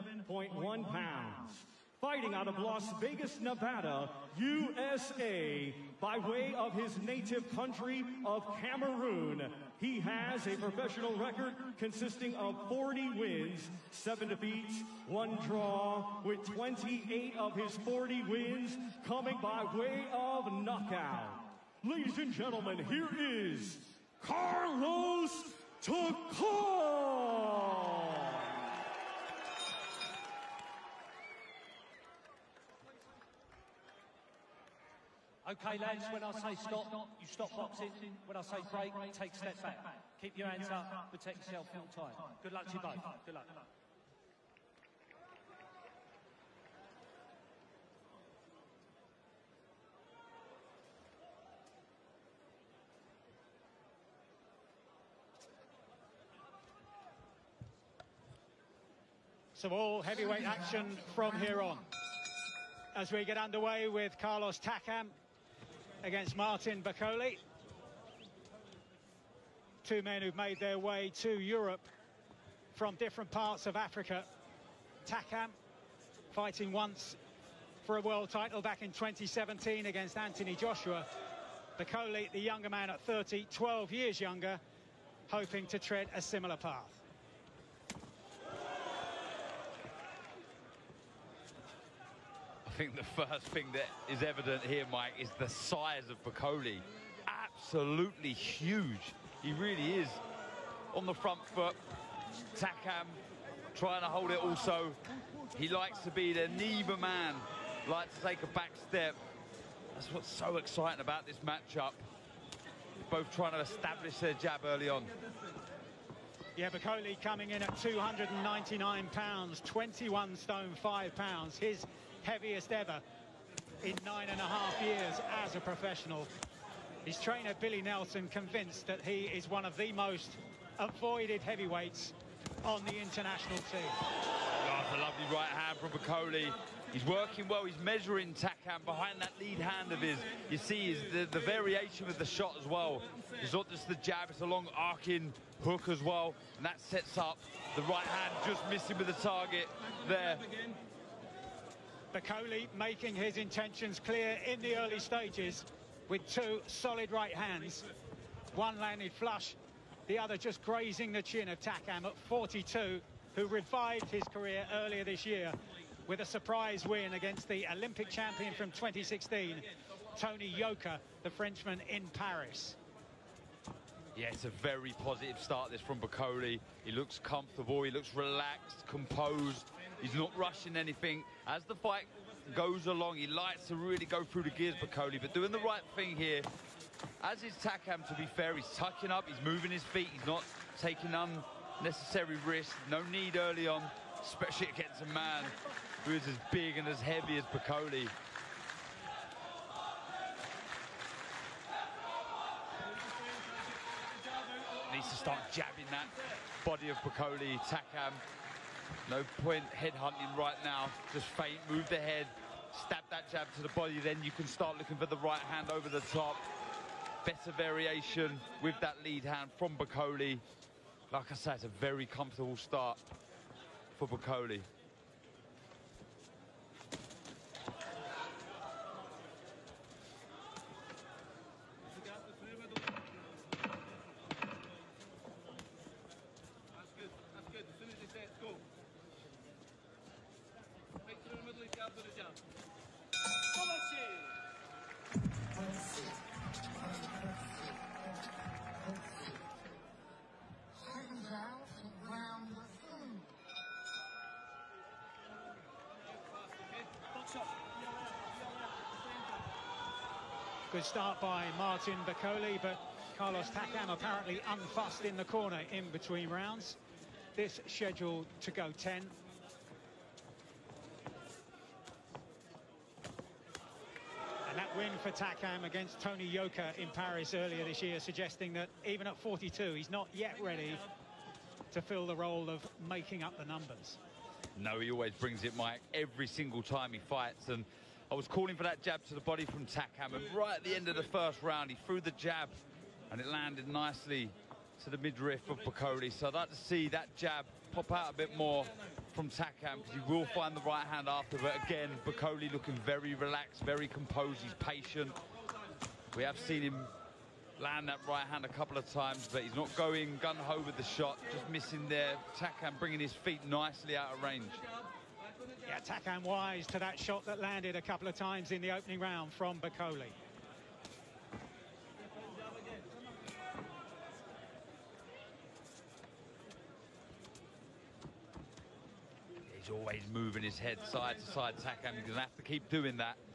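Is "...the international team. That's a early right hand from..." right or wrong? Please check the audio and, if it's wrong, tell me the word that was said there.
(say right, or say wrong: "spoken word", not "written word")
wrong: "lovely", not "early".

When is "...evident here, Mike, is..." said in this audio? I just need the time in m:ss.
1:34.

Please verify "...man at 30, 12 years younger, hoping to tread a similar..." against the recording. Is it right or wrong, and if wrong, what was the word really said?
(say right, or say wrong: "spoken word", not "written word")
right.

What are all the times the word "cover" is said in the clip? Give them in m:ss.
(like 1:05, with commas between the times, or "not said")
not said.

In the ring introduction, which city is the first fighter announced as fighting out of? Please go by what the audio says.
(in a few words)
Las Vegas.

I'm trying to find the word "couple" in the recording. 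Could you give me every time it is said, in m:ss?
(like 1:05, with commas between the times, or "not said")
5:08, 5:17.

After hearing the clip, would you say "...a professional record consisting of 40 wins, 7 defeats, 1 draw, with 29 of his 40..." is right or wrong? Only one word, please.
wrong.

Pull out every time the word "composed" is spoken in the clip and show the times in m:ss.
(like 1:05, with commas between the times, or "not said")
2:58, 5:03.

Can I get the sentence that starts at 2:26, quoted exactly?
And that sets up the right hand just missing with the target there.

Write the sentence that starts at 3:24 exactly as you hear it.
Needs to start jabbing that body of Bakole, Takam.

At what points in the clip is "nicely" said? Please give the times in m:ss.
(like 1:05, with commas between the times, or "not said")
4:53, 5:13.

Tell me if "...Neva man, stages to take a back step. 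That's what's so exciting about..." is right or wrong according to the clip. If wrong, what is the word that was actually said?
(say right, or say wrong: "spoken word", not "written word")
wrong: "likes", not "stages".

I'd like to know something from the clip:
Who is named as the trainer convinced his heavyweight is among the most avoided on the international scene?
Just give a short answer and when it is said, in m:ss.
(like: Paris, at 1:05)
Billy Nelson, at 2:07.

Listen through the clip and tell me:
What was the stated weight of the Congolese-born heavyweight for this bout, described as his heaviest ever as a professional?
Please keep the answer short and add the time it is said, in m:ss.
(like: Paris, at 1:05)
299 pounds, at 1:57.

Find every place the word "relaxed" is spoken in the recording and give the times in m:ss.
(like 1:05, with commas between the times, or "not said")
2:58, 5:03.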